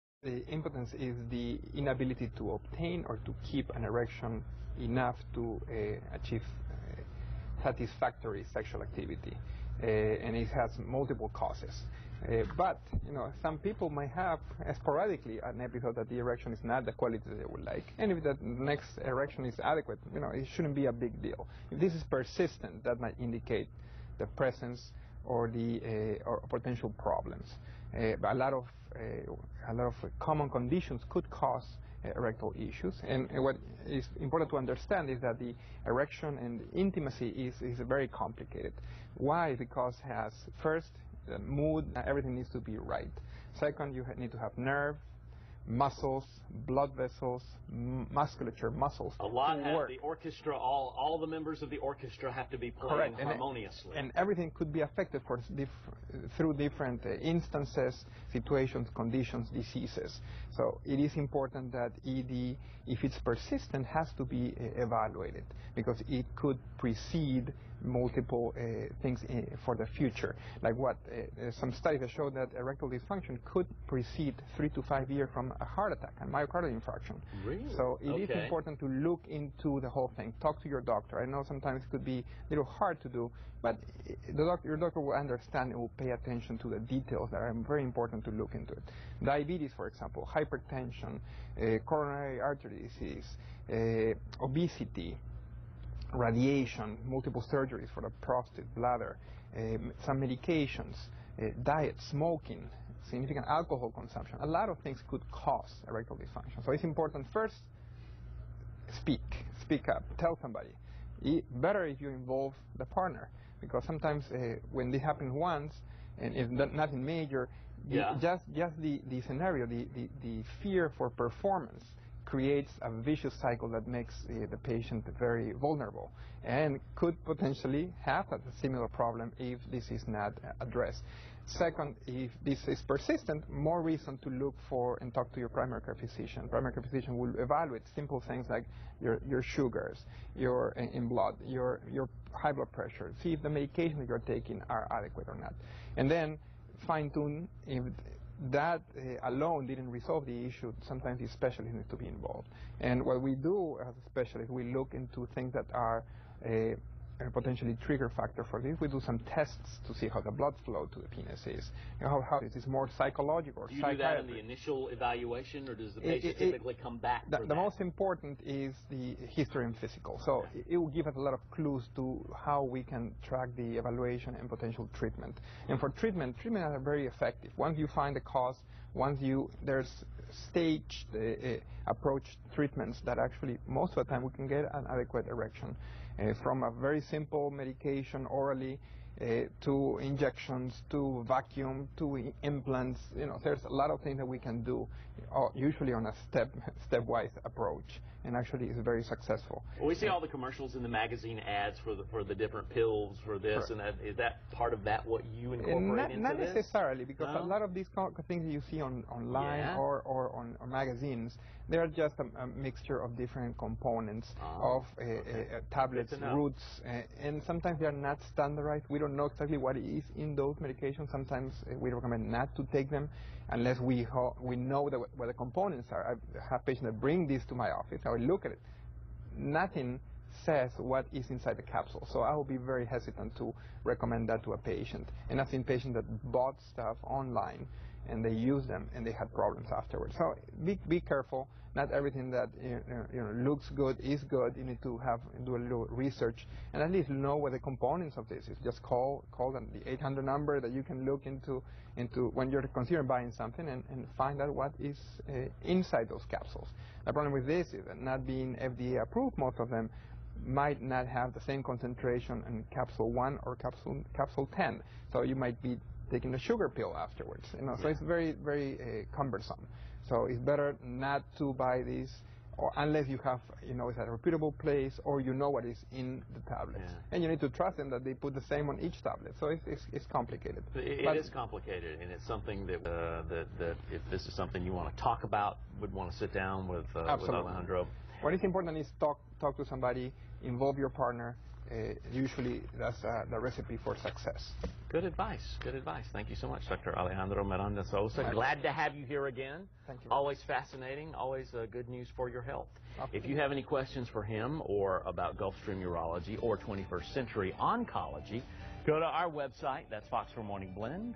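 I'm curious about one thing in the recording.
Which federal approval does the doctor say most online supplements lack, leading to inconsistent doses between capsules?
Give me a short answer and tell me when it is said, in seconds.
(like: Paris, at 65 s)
FDA approved, at 258 s.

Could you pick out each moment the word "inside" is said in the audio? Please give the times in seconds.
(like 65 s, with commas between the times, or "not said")
231 s, 255 s.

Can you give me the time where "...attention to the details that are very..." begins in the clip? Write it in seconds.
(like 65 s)
86 s.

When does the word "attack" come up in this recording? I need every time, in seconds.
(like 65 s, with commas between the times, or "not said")
75 s.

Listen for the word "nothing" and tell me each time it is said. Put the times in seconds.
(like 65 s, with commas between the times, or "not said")
116 s, 229 s.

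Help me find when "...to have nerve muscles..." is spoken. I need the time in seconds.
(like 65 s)
44 s.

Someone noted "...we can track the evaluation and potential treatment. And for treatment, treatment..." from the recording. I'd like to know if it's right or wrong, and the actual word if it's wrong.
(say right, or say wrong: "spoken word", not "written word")
right.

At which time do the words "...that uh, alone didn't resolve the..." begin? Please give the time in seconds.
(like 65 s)
148 s.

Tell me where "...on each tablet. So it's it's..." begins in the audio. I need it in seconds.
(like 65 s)
278 s.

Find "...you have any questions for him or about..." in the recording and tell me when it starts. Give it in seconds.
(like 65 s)
303 s.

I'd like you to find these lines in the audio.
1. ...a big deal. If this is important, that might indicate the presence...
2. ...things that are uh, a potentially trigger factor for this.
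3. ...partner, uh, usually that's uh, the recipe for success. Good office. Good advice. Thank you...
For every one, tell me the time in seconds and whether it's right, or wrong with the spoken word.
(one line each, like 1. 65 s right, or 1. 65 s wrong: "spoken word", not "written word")
1. 20 s wrong: "persistent", not "important"
2. 155 s right
3. 290 s wrong: "advice", not "office".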